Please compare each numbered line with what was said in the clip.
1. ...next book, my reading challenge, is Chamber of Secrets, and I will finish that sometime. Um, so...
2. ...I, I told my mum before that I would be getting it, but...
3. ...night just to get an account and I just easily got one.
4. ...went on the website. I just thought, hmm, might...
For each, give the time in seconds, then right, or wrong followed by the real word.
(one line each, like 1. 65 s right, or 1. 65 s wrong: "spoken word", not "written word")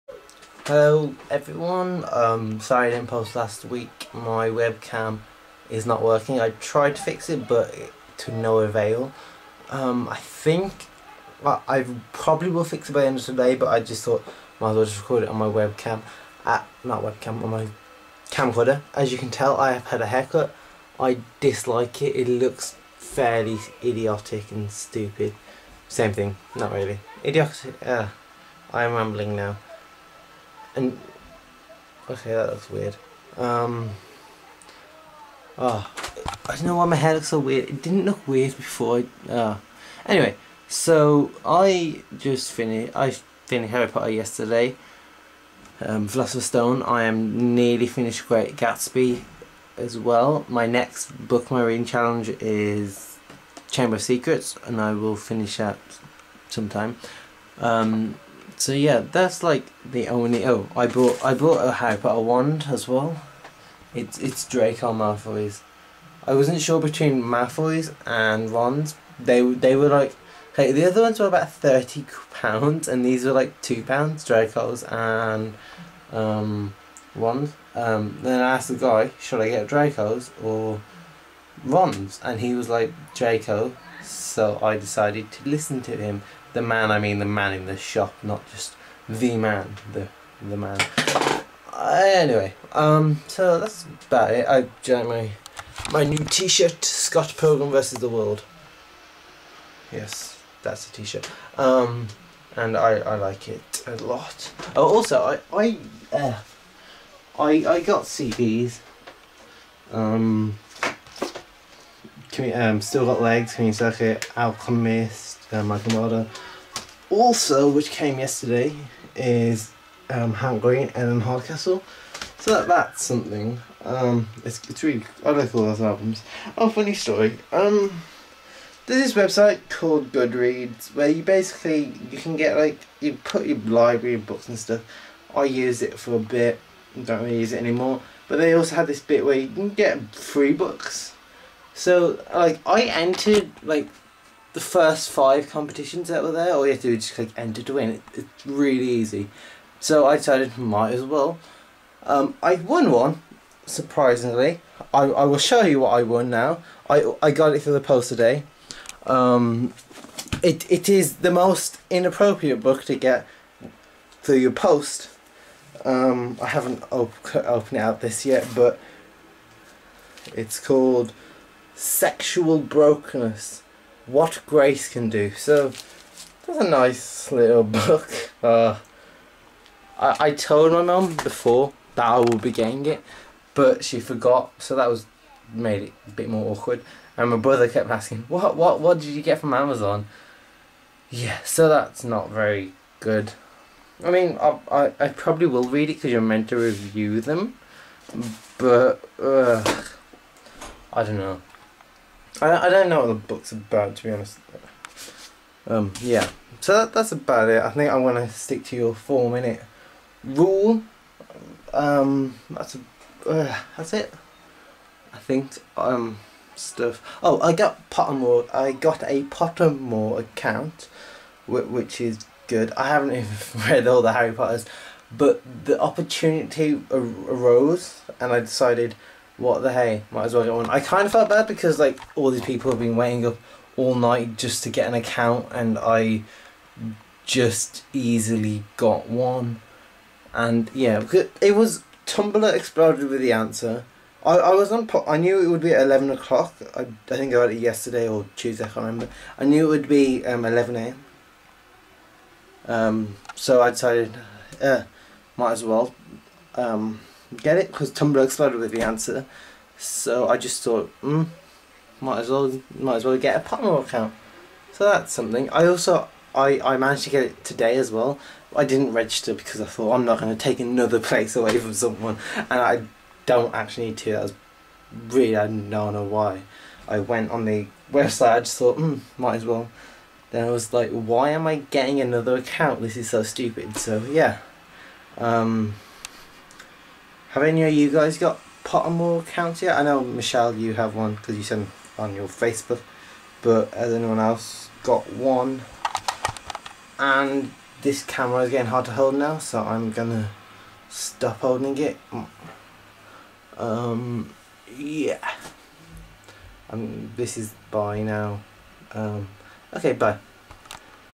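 1. 50 s right
2. 179 s right
3. 233 s right
4. 276 s right.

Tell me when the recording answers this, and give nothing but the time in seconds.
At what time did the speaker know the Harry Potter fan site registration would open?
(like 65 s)
250 s.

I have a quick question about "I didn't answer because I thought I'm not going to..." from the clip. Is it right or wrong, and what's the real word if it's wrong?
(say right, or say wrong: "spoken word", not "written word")
wrong: "register", not "answer".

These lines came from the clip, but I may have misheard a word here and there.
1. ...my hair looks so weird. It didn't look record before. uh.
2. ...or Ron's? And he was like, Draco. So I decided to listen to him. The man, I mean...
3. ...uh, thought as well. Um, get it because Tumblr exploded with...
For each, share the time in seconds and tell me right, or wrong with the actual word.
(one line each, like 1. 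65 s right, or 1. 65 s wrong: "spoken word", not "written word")
1. 36 s wrong: "weird", not "record"
2. 80 s right
3. 254 s wrong: "might", not "thought".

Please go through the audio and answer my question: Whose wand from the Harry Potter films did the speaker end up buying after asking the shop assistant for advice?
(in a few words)
Draco Malfoy's.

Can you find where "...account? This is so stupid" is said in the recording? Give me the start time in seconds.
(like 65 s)
282 s.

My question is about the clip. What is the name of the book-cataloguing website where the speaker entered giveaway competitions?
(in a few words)
Goodreads.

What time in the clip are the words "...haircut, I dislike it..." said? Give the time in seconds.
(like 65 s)
20 s.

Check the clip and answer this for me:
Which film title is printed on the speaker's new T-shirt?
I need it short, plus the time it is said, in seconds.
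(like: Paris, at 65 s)
Scott Pilgrim versus the World, at 96 s.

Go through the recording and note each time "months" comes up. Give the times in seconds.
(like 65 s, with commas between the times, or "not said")
not said.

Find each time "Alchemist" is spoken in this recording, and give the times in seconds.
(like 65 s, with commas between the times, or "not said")
114 s.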